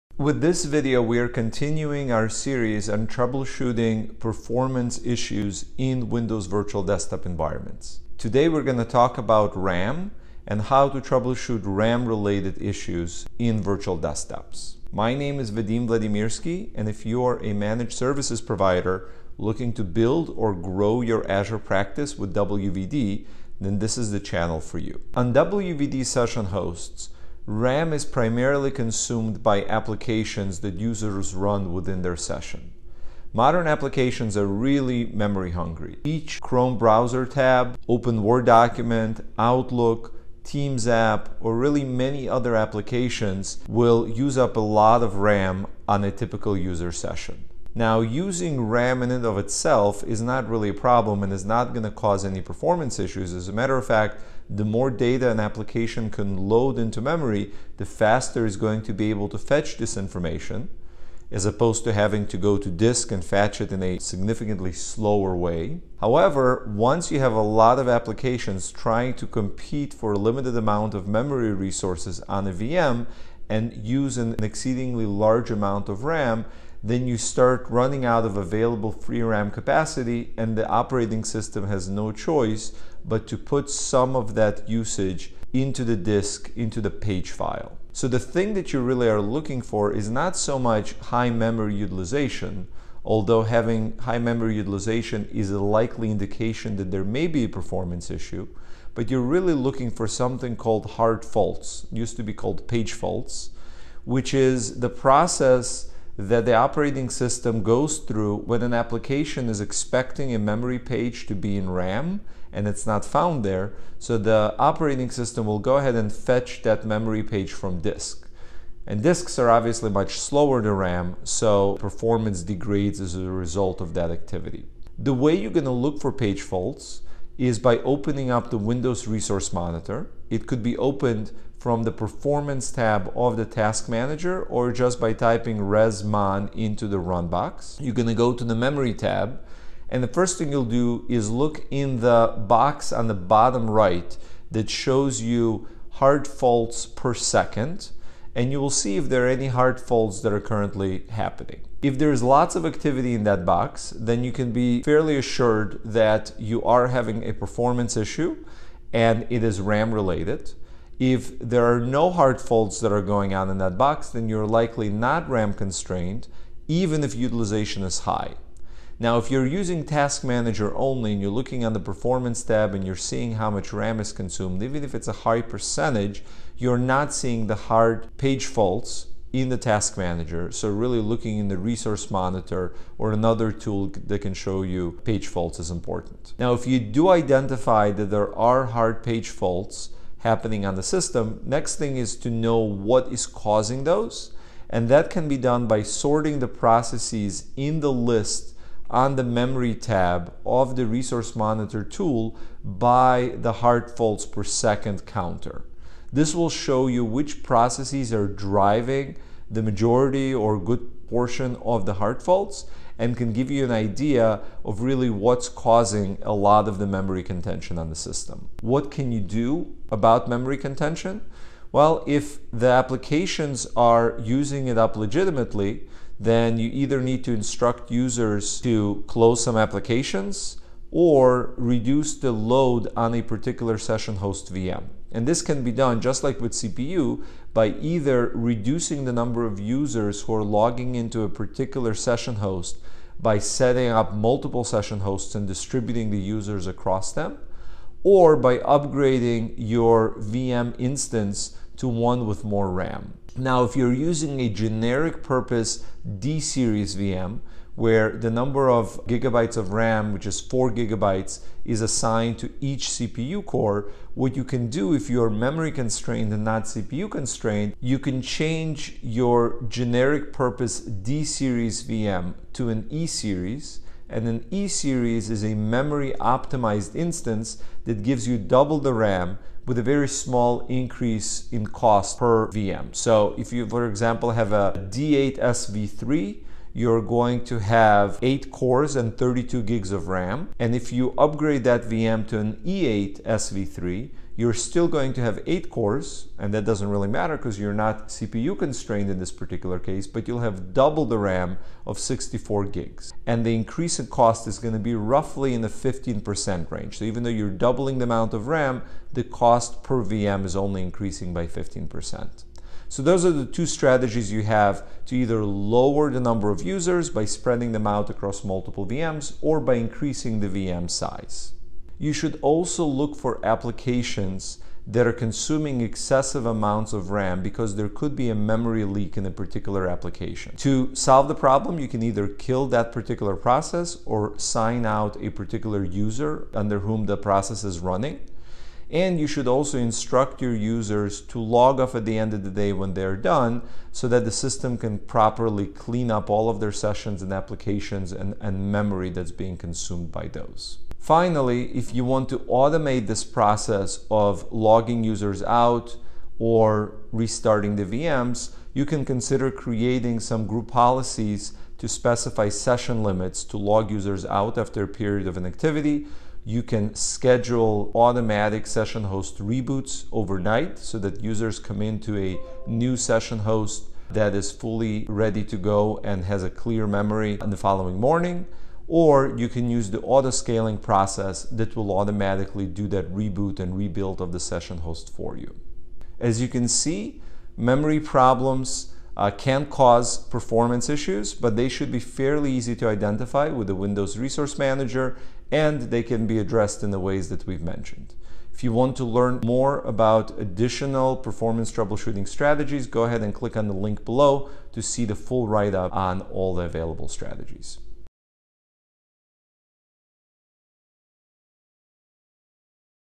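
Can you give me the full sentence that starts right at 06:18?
Or you can use the auto scaling process that will automatically do that reboot and rebuild of the session host for you.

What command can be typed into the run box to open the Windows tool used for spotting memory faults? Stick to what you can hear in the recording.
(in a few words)
resmon.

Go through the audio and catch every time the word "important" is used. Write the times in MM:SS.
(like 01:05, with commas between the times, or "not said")
03:05.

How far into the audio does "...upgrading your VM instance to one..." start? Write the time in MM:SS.
04:08.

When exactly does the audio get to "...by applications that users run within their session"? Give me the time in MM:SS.
00:29.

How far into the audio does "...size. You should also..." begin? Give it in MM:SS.
05:20.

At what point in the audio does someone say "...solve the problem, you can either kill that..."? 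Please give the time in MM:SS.
05:30.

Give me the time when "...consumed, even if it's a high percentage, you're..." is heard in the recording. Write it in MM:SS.
02:54.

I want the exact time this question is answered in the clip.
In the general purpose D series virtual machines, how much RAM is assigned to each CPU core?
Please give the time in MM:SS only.
04:20.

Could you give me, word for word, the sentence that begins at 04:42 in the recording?
So if you, for example, have a D8SV3, you're going to have 8 cores and 32 gigs of RAM.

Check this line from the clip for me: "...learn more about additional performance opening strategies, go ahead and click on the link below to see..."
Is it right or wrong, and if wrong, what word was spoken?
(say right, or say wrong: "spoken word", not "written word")
wrong: "troubleshooting", not "opening".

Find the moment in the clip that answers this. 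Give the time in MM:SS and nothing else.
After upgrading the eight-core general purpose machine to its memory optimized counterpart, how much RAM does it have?
05:01.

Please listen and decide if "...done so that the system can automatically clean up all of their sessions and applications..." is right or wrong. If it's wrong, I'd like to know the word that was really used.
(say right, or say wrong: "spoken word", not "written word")
wrong: "properly", not "automatically".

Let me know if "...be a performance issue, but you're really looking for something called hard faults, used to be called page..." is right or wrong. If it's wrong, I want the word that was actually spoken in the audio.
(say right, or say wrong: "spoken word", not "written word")
right.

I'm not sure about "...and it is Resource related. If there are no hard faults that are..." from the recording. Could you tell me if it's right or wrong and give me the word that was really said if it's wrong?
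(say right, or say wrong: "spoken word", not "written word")
wrong: "RAM", not "Resource".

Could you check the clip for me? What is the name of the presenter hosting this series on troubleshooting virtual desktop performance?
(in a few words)
Vadim Vladimirskiy.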